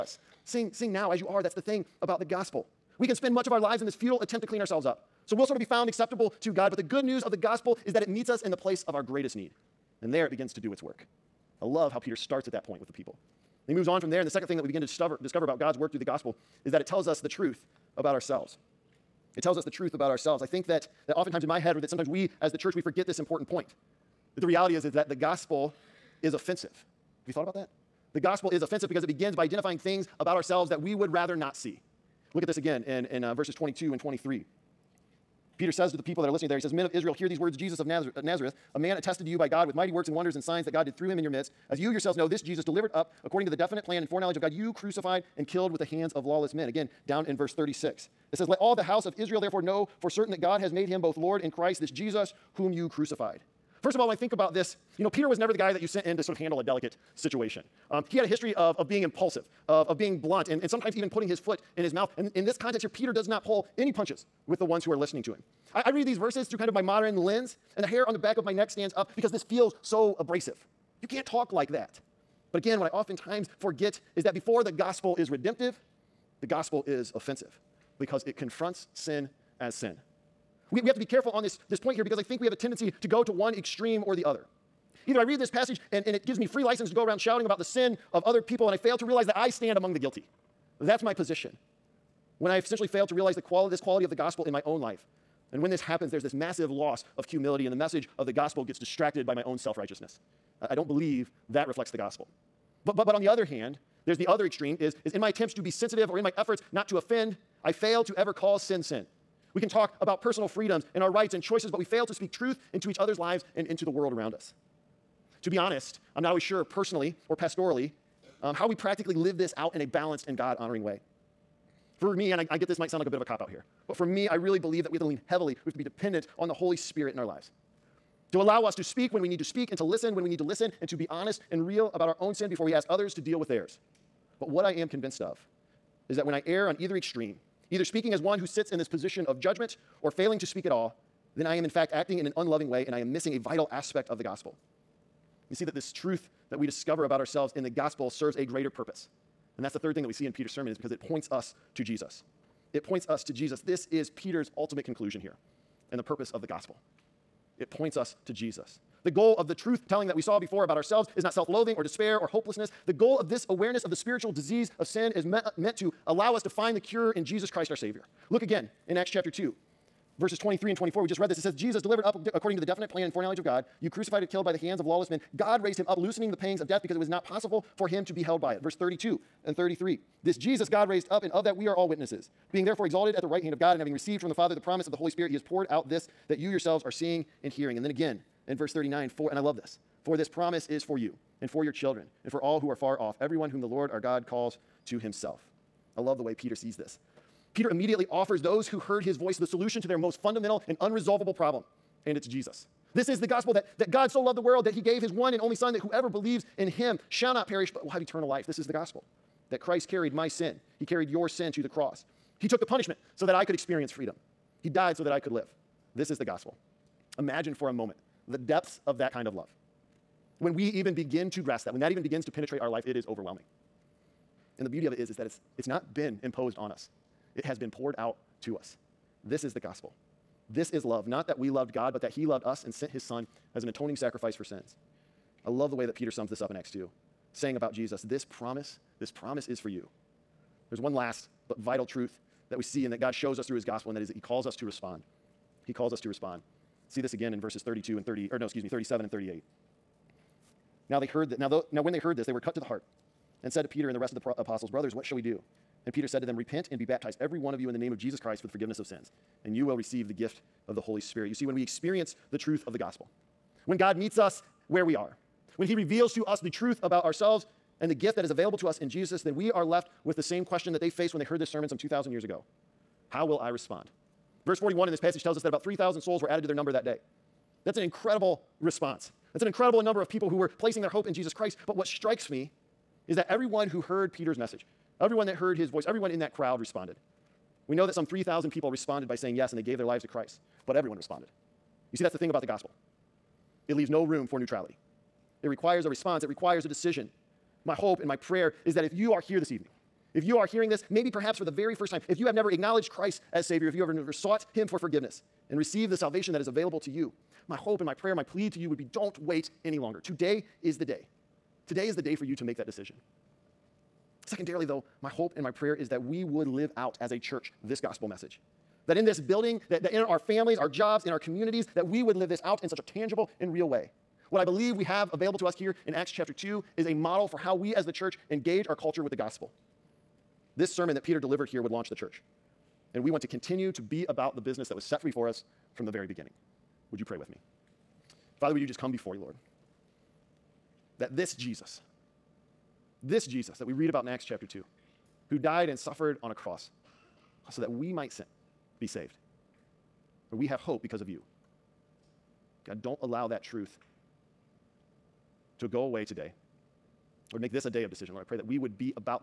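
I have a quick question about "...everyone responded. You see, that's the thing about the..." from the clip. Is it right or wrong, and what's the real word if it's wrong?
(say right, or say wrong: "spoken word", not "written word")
right.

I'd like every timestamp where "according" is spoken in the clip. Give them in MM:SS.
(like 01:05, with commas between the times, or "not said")
00:43, 02:52.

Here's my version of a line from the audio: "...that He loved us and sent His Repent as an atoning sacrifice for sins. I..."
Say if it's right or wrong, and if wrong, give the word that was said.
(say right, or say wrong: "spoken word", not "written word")
wrong: "Son", not "Repent".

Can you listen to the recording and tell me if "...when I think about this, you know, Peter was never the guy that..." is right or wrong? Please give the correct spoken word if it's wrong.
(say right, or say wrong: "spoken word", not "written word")
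right.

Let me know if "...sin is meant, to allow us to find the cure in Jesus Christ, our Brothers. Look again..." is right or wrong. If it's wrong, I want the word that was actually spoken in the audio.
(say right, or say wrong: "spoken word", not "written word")
wrong: "Savior", not "Brothers".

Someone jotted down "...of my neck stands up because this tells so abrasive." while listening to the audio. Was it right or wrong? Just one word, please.
wrong.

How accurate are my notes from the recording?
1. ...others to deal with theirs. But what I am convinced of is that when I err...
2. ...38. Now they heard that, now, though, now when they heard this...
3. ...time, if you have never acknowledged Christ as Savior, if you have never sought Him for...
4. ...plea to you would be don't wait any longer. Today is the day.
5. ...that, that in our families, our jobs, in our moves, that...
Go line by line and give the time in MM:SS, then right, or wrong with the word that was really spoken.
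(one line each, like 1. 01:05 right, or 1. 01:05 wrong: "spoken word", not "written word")
1. 02:12 right
2. 04:09 right
3. 05:01 right
4. 05:08 right
5. 05:19 wrong: "communities", not "moves".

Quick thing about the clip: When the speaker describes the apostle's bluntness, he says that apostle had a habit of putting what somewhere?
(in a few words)
his foot in his mouth.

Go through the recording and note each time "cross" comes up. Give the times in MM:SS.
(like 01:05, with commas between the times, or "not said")
03:31, 05:46.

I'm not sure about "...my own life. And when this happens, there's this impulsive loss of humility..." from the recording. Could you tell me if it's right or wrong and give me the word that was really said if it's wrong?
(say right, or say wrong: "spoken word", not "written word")
wrong: "massive", not "impulsive".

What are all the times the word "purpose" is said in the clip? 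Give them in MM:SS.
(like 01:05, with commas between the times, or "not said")
02:28, 02:36.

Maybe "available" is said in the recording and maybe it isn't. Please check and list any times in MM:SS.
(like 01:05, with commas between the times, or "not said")
04:28, 05:06, 05:25.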